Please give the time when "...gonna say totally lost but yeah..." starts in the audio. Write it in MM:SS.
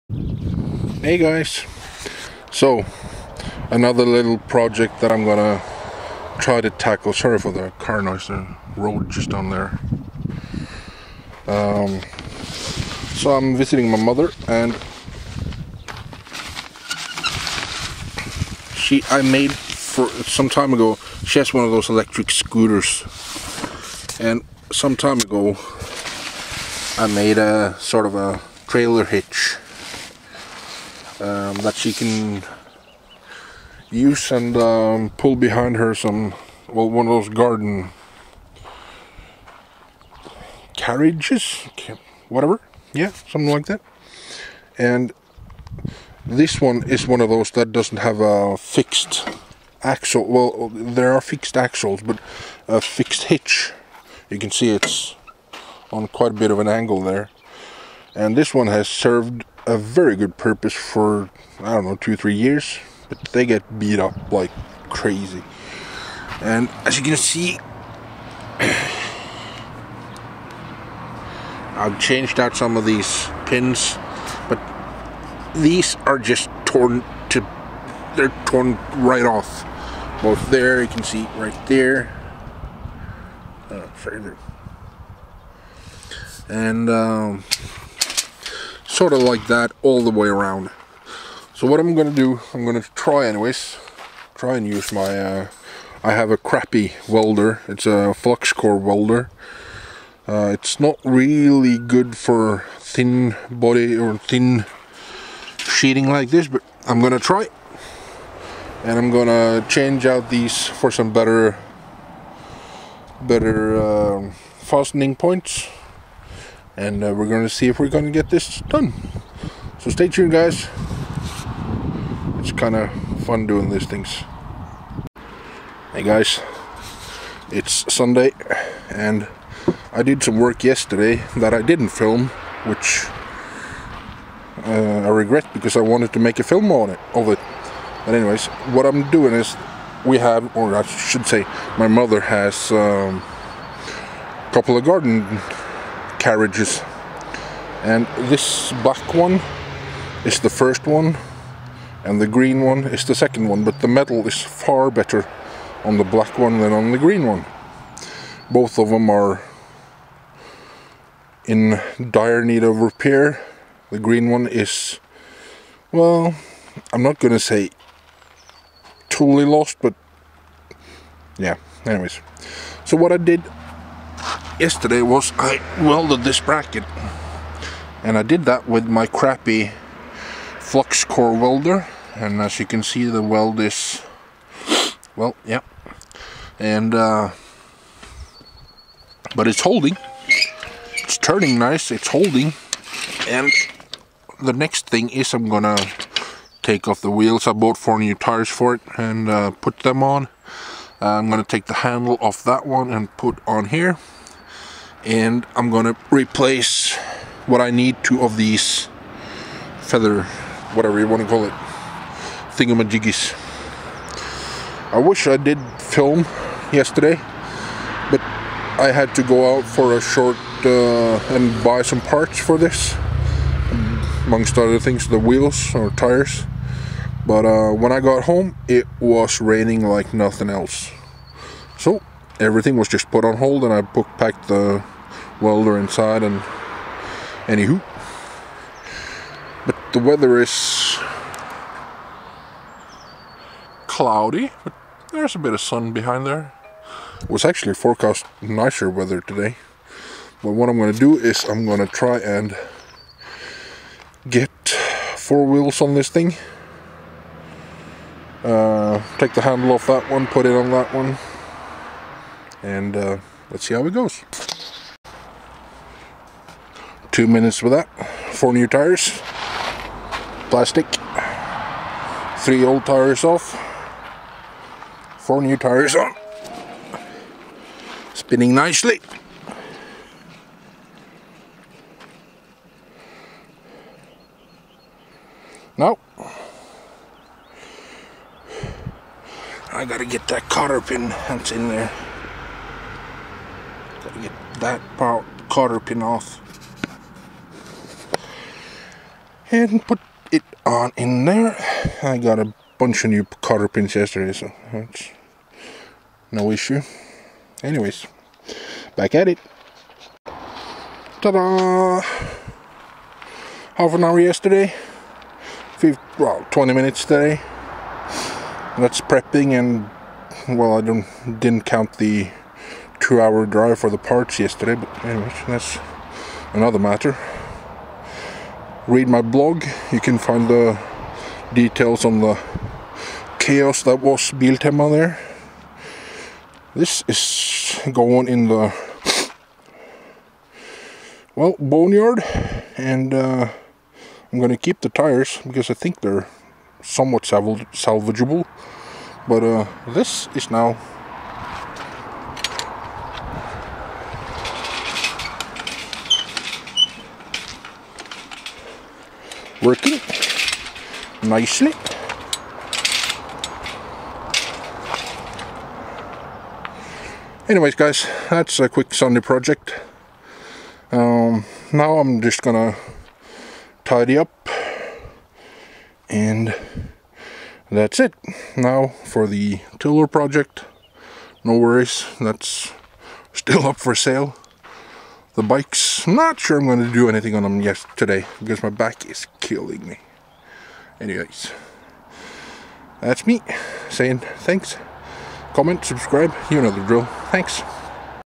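02:47.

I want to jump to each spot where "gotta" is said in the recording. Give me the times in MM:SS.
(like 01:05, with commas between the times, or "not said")
04:49, 04:54.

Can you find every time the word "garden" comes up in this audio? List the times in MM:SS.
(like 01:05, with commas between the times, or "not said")
00:37, 02:24.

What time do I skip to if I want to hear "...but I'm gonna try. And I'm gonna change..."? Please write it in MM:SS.
01:46.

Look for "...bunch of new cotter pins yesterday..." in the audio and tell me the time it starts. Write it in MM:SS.
05:02.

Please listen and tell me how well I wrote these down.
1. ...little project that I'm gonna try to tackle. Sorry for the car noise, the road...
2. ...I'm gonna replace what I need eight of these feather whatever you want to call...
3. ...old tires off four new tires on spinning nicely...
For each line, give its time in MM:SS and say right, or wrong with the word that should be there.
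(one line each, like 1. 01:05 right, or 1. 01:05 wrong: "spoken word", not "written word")
1. 00:04 right
2. 03:25 wrong: "two", not "eight"
3. 04:32 right.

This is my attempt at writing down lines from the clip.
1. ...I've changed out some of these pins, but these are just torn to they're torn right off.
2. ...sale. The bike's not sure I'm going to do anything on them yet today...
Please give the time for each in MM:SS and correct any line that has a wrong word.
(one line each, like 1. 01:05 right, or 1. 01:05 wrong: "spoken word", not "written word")
1. 01:11 right
2. 06:23 right.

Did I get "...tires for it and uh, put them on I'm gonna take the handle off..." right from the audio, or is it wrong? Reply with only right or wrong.
right.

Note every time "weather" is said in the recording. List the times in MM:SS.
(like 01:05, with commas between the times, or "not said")
03:59, 04:08.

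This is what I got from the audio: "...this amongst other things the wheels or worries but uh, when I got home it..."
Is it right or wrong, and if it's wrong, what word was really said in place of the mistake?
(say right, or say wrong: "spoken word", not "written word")
wrong: "tires", not "worries".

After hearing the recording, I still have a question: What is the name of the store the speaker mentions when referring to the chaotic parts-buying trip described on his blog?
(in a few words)
Biltema.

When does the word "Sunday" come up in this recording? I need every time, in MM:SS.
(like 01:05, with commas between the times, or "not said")
02:07, 06:08.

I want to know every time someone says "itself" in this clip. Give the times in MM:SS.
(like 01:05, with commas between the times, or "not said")
not said.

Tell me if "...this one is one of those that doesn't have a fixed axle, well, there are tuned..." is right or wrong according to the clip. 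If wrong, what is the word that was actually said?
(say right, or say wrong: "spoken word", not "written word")
wrong: "fixed", not "tuned".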